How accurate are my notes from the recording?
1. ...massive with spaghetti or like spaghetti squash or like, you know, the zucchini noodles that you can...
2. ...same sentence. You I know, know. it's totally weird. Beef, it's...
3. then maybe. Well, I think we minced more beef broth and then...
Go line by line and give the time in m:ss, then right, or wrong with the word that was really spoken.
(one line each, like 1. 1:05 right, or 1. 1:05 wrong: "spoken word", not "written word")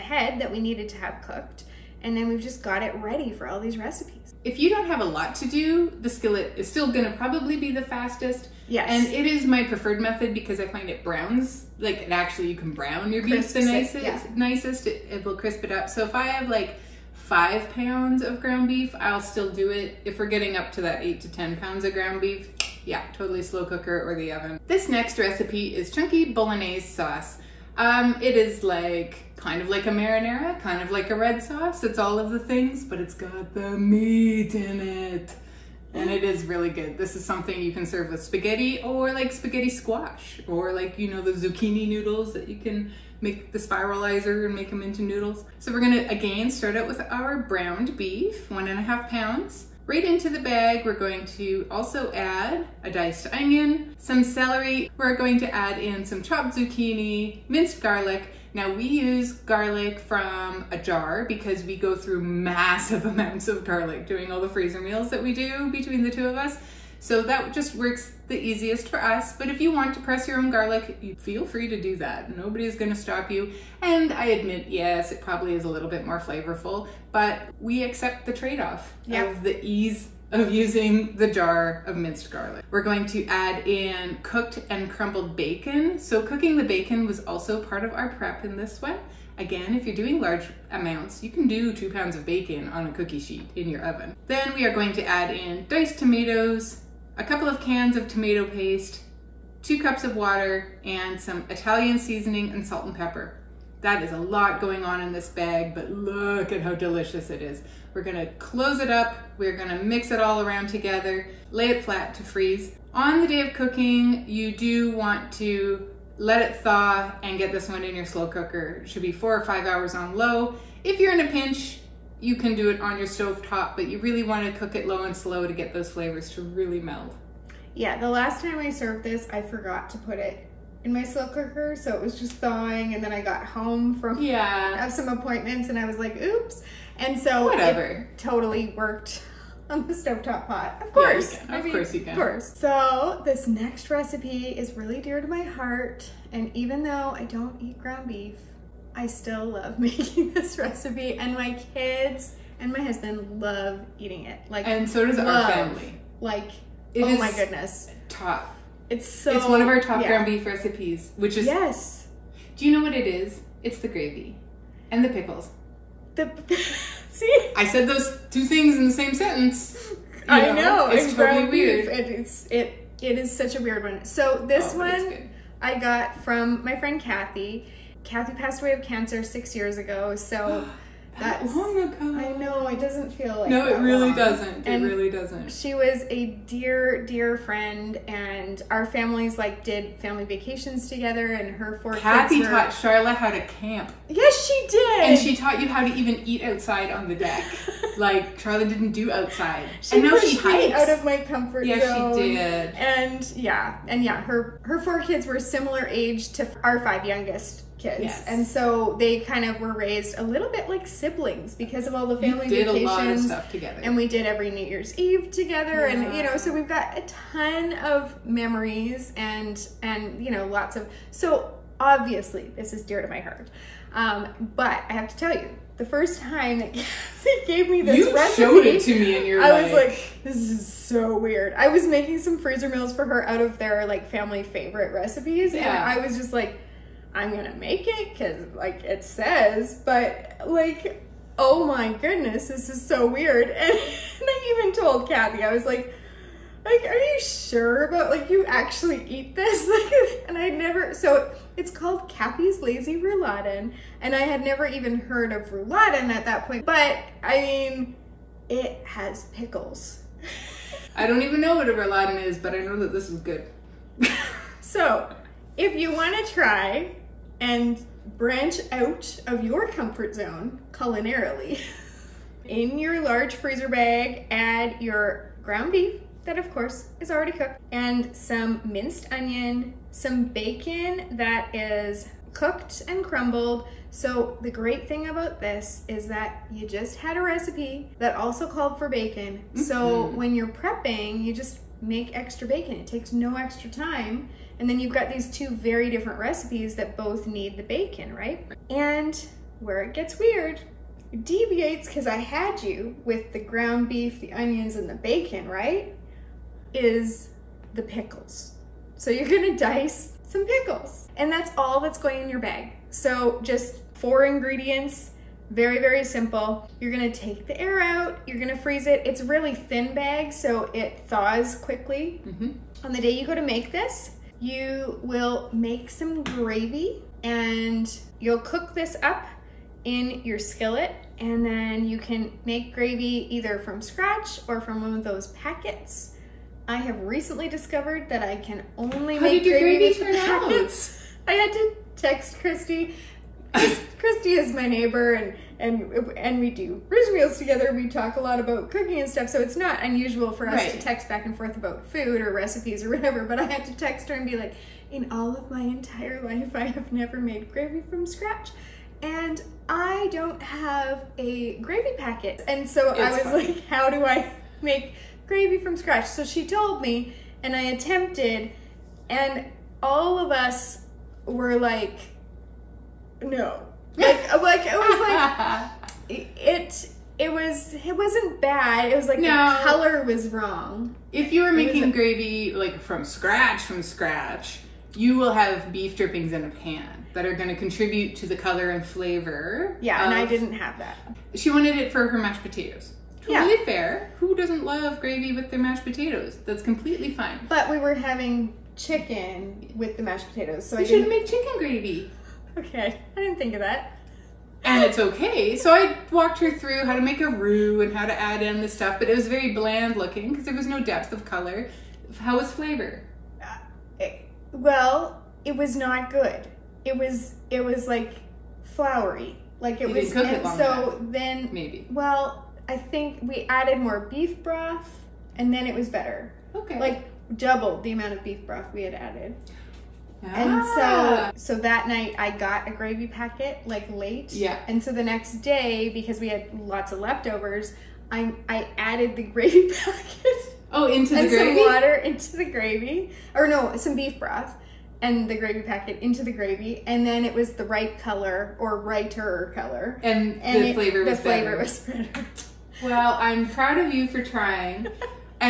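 1. 0:37 wrong: "serve", not "massive"
2. 2:48 right
3. 7:01 wrong: "added", not "minced".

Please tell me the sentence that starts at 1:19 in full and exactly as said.
of the ease of using the jar of minced garlic.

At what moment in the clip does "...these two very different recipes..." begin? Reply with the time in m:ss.
4:55.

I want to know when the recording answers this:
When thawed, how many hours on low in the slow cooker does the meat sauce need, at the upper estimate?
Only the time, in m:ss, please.
1:59.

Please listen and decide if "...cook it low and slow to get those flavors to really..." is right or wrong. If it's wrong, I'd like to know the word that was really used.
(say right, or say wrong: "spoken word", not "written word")
right.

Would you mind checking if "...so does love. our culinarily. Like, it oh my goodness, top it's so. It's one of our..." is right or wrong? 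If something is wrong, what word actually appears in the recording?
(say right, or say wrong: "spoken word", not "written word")
wrong: "family", not "culinarily".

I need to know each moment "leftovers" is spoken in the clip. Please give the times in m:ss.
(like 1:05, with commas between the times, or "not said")
7:16.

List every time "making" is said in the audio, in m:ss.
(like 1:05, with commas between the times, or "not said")
2:29, 3:51, 6:21.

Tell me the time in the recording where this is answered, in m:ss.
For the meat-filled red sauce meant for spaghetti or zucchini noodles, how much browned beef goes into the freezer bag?
0:48.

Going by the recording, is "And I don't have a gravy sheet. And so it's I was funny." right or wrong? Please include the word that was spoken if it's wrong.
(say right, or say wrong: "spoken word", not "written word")
wrong: "packet", not "sheet".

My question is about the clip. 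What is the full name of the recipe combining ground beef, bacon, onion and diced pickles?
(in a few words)
Cathy's Lazy Rouladen.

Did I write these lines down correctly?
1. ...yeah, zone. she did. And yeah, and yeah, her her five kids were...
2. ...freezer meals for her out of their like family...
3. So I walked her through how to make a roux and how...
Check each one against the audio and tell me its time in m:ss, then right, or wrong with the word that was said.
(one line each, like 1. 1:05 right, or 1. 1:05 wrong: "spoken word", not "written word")
1. 3:21 wrong: "four", not "five"
2. 3:52 right
3. 6:45 right.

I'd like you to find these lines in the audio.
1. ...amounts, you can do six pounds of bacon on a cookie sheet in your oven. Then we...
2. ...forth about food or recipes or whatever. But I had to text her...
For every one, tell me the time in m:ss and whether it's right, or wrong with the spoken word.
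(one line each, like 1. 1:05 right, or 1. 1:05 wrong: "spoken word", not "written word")
1. 1:30 wrong: "two", not "six"
2. 5:51 right.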